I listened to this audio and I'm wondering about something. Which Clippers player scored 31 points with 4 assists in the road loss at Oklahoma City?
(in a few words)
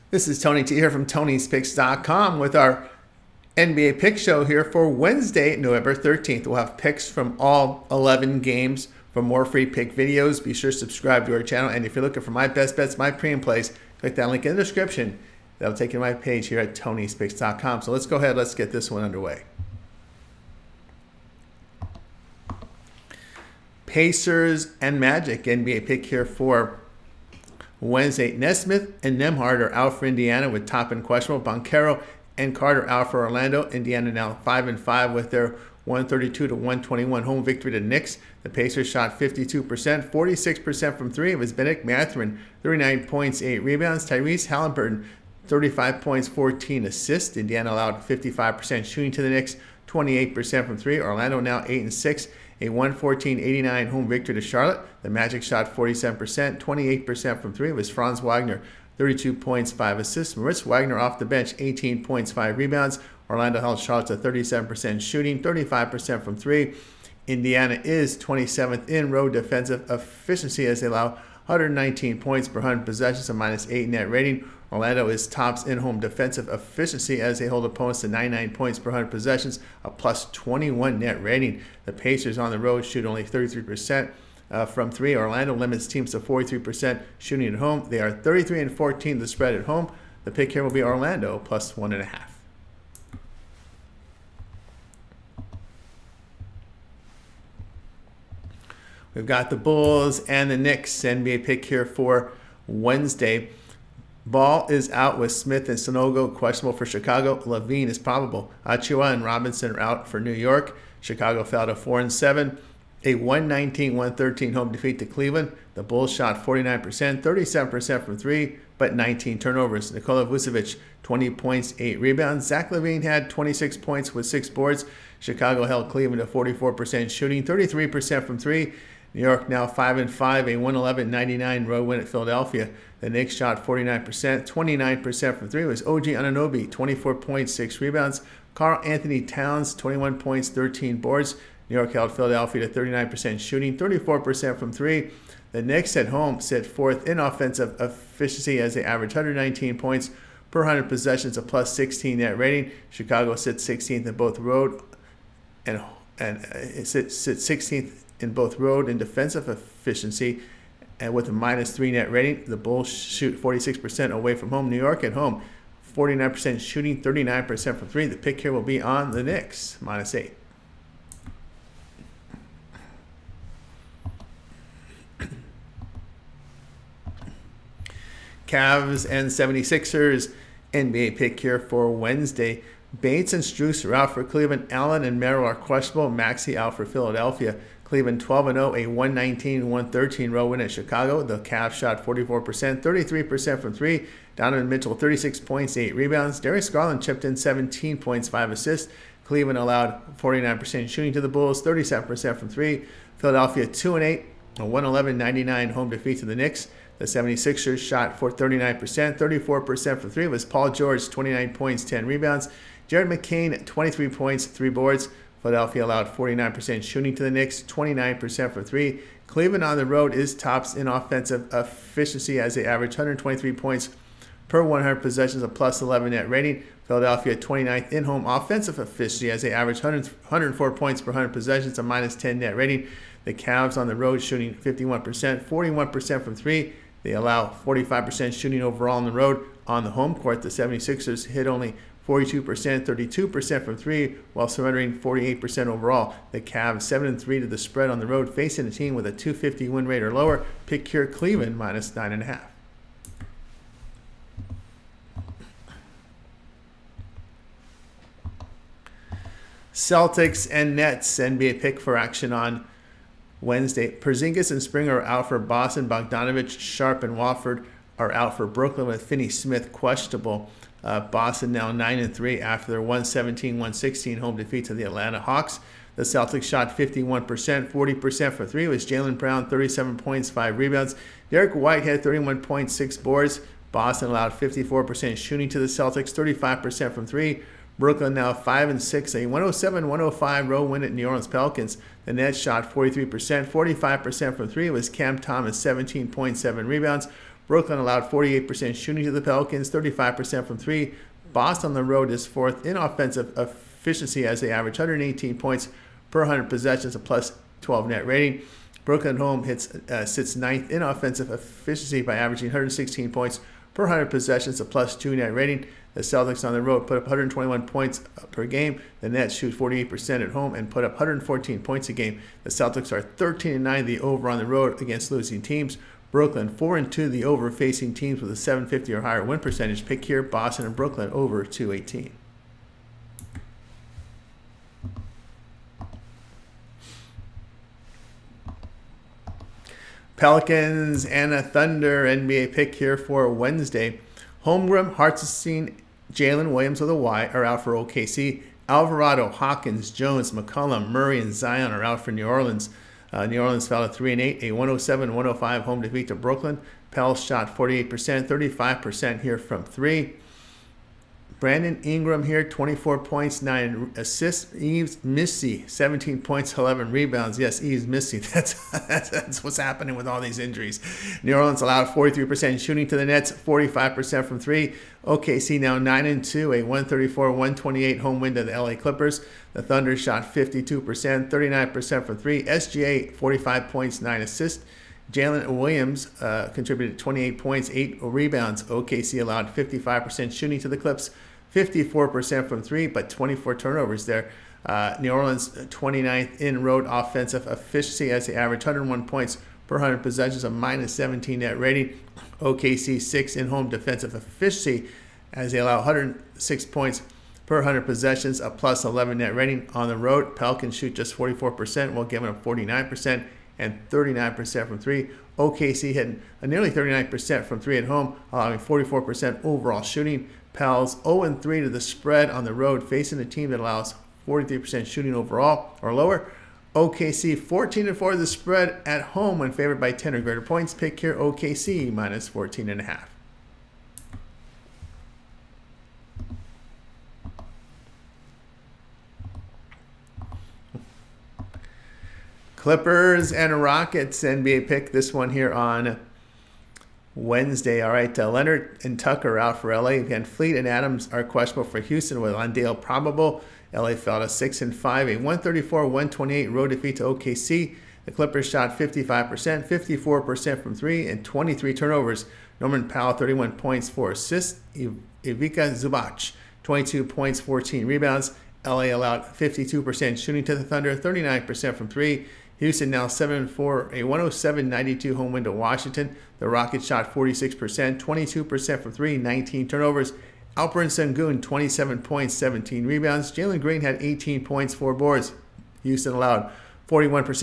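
Norman Powell.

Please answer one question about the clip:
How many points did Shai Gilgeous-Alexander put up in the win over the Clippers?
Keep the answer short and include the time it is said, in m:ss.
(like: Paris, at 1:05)
45, at 6:23.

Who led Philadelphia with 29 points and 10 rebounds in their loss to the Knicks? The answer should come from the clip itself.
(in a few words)
Paul George.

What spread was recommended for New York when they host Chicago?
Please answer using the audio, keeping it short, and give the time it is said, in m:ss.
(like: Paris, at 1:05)
-8, at 2:49.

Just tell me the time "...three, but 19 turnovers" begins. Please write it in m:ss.
1:58.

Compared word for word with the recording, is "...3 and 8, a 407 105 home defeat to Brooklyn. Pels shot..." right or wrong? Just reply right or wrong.
wrong.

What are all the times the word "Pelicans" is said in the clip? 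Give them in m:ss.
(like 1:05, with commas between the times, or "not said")
4:51, 4:59, 5:40, 6:50.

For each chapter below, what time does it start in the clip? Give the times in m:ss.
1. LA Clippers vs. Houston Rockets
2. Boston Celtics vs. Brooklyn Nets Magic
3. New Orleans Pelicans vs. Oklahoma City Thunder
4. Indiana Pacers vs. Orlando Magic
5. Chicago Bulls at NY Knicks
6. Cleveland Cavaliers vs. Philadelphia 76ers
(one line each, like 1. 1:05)
1. 7:22
2. 4:19
3. 5:39
4. 0:22
5. 1:38
6. 2:58.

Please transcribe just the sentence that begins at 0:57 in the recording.
It was Franz Wagner, 32 points, 5 assists.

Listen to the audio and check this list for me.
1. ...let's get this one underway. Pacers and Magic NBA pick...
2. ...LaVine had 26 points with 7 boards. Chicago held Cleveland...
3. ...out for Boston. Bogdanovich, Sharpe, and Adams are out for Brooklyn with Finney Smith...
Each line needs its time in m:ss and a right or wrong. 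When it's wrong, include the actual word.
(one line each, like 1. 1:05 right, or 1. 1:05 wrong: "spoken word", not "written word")
1. 0:18 right
2. 2:02 wrong: "6", not "7"
3. 4:25 wrong: "Watford", not "Adams".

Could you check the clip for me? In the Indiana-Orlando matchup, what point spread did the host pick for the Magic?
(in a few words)
+1.5.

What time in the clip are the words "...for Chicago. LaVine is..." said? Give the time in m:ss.
1:46.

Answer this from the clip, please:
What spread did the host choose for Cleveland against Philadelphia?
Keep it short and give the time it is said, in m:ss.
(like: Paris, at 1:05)
-9.5, at 4:11.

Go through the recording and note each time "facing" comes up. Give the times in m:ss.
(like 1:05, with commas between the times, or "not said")
4:08, 5:27, 7:02.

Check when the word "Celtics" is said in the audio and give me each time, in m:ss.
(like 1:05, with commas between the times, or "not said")
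4:19, 4:36, 4:45, 5:16, 5:22.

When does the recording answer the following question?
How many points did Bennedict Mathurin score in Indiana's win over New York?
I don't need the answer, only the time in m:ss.
0:42.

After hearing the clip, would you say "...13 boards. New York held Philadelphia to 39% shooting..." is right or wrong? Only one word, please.
right.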